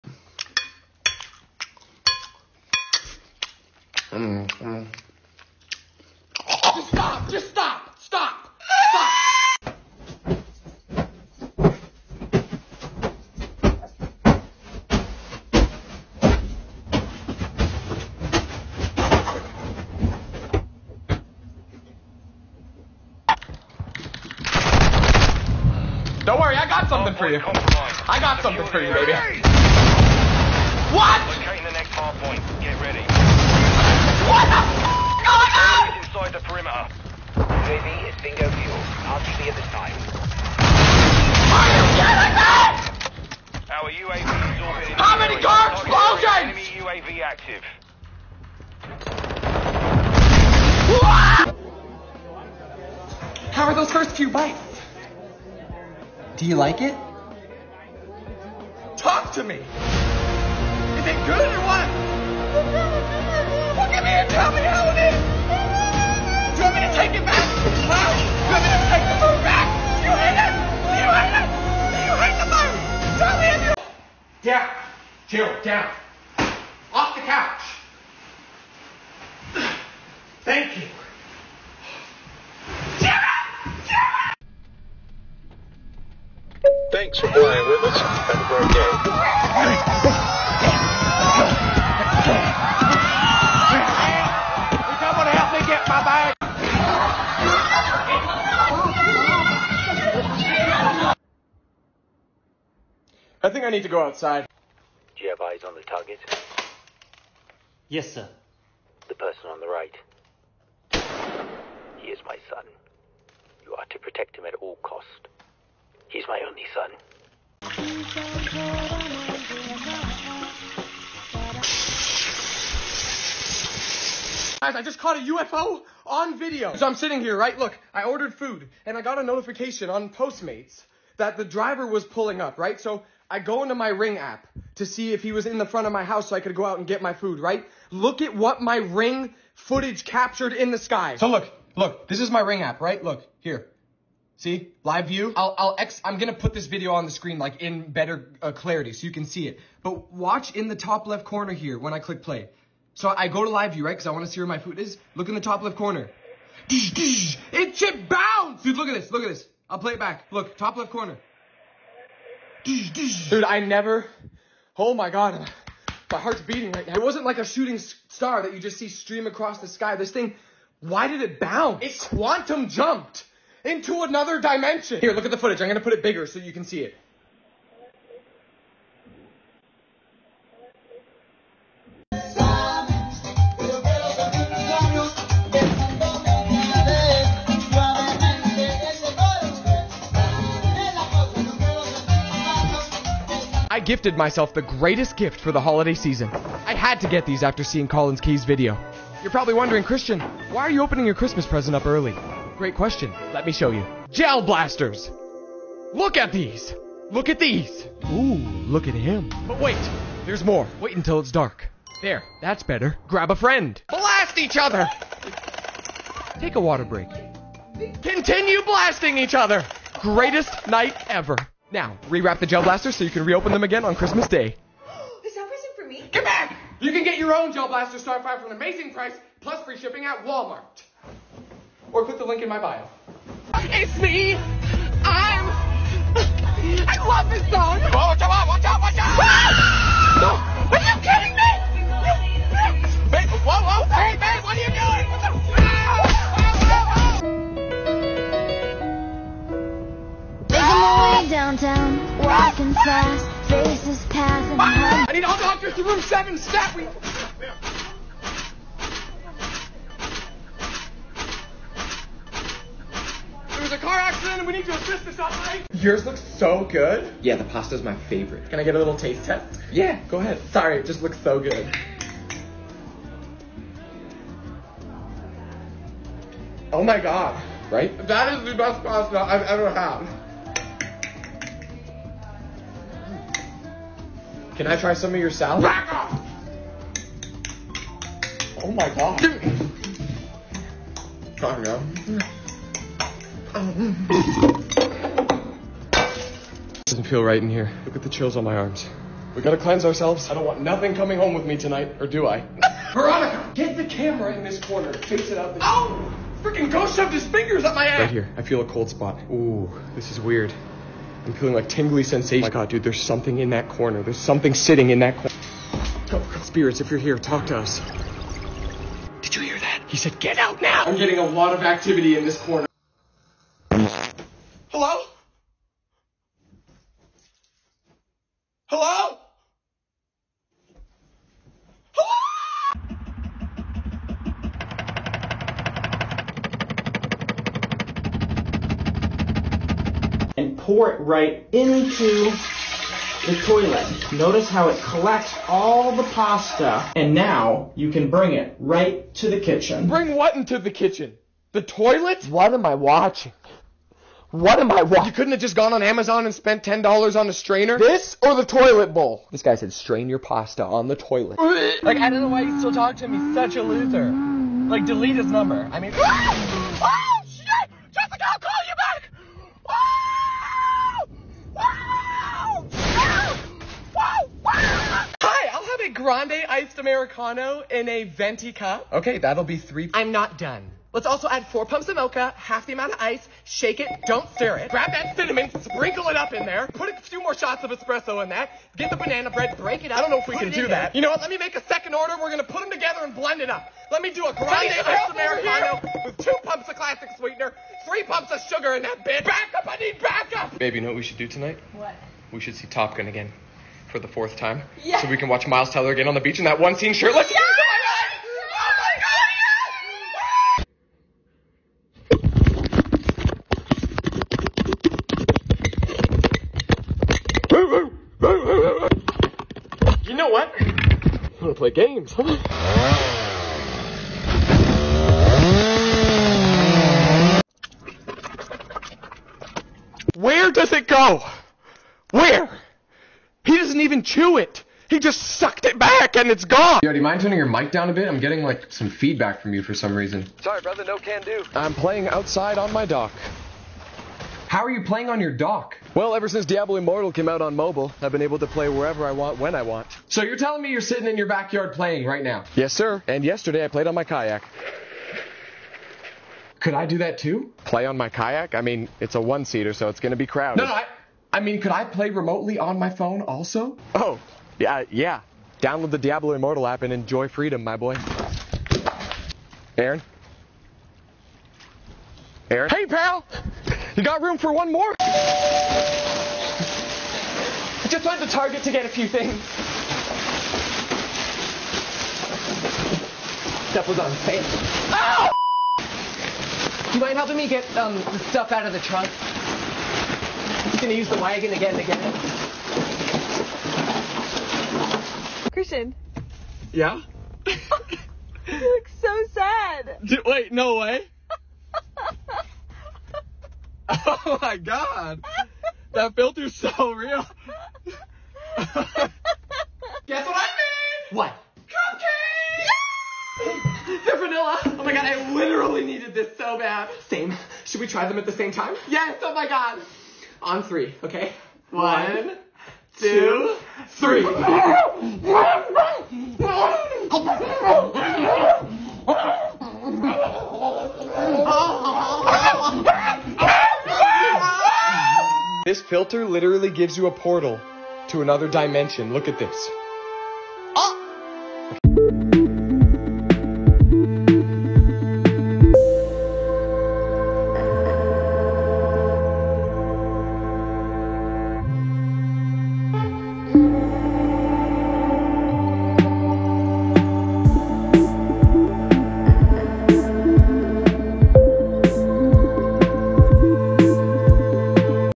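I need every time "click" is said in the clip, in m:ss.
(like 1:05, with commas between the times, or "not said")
2:31, 3:52.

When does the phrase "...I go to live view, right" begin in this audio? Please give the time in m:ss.
2:33.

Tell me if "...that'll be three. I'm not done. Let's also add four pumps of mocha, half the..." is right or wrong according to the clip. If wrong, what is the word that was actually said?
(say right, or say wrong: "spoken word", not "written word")
right.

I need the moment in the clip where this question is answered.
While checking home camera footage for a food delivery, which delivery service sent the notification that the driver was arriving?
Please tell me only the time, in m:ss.
2:10.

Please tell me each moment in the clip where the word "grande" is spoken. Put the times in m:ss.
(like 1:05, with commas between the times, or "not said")
6:16, 6:34.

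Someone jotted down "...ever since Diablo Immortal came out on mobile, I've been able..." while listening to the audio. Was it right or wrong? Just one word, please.
right.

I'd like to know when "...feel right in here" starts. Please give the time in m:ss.
4:57.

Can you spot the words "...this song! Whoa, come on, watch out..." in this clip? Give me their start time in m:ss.
3:57.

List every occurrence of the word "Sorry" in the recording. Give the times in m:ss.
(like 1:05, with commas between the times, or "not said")
4:30, 7:20.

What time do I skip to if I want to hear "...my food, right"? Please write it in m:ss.
2:17.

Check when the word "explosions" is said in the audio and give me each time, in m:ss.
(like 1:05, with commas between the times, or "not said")
0:45.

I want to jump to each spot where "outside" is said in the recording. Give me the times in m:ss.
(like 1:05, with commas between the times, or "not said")
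1:44, 7:22.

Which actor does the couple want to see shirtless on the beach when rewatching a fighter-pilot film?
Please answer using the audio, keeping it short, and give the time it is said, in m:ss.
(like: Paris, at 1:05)
Miles Teller, at 6:45.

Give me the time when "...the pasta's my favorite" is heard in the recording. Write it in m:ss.
4:27.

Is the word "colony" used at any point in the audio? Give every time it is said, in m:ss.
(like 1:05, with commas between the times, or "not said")
not said.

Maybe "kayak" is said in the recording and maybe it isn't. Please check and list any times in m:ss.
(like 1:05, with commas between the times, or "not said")
7:34, 7:38.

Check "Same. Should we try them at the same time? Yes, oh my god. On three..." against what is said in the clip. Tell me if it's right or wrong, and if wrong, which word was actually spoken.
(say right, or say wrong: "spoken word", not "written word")
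right.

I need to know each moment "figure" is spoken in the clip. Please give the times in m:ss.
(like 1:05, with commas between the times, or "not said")
not said.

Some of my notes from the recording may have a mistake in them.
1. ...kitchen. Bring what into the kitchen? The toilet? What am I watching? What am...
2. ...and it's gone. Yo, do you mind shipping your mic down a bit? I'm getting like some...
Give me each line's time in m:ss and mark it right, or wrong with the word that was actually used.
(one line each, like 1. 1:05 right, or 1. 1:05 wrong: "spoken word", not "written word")
1. 5:49 right
2. 7:16 wrong: "turning", not "shipping".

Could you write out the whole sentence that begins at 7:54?
I just went to Target to get a few things.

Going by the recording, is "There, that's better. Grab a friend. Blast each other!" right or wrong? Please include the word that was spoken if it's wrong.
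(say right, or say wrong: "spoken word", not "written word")
right.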